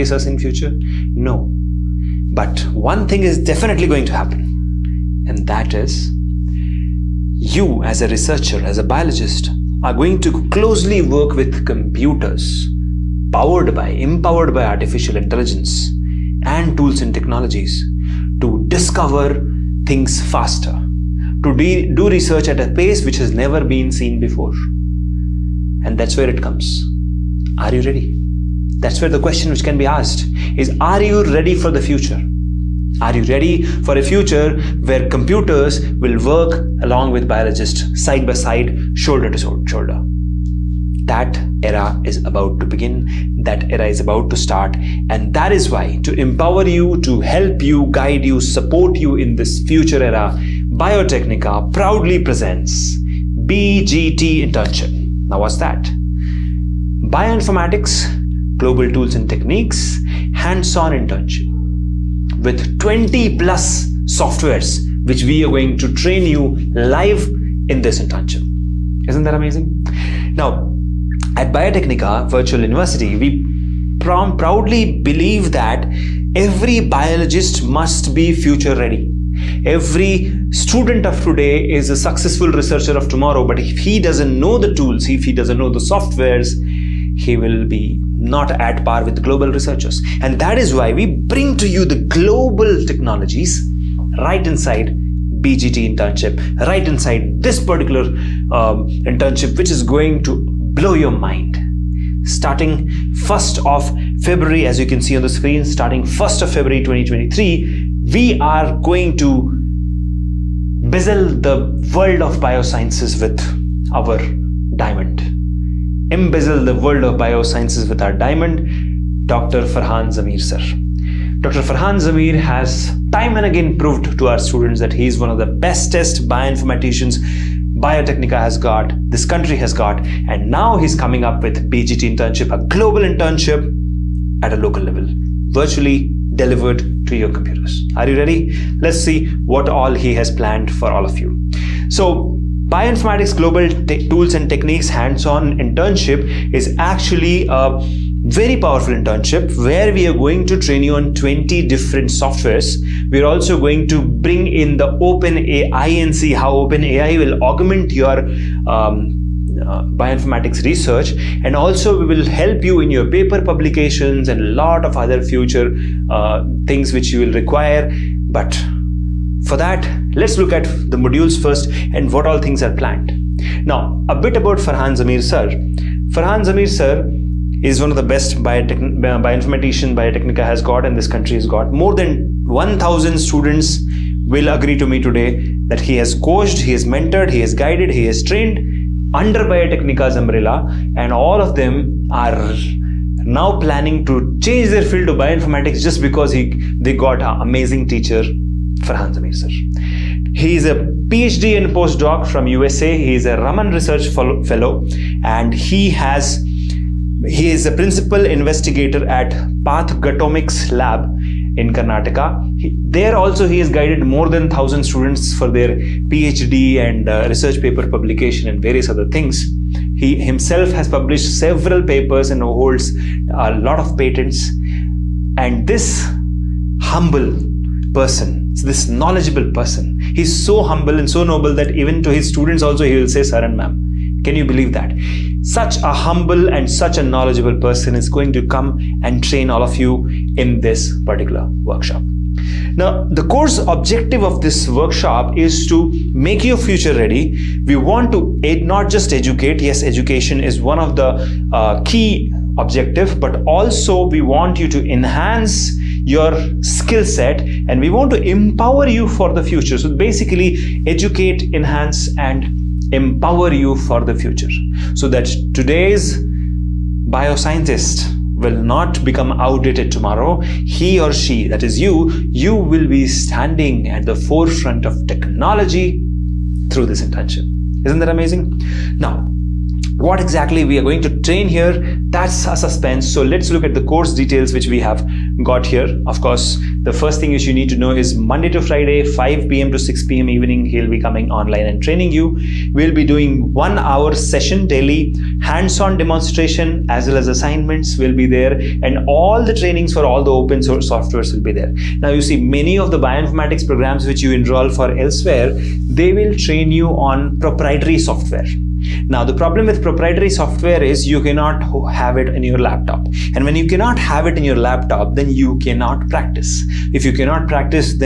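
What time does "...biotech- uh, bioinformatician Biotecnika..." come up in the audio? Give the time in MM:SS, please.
02:58.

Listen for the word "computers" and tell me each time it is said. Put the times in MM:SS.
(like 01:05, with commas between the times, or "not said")
00:11, 00:35, 02:17.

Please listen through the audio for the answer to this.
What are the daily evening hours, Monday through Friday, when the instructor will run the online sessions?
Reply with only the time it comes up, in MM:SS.
04:49.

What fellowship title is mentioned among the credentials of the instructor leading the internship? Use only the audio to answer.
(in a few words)
Raman Research Fellow.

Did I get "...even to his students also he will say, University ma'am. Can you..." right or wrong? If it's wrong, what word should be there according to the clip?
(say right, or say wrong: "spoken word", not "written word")
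wrong: "Saran", not "University".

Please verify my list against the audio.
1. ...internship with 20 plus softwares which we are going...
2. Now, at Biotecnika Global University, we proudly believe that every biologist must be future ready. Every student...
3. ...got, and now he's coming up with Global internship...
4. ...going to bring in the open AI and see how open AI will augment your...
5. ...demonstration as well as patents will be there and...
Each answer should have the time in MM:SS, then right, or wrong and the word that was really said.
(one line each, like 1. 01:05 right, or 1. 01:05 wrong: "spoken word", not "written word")
1. 01:00 right
2. 01:10 wrong: "Virtual", not "Global"
3. 02:09 wrong: "BGT", not "Global"
4. 02:33 right
5. 04:55 wrong: "assignments", not "patents".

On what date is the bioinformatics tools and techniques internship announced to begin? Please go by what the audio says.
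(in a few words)
1 February 2023.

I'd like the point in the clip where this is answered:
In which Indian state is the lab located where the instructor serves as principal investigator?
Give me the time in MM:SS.
03:31.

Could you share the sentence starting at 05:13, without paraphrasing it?
And when you cannot have it in your laptop, then you cannot practice.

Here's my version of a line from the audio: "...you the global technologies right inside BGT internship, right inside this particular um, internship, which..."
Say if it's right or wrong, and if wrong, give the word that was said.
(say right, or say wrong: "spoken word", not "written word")
right.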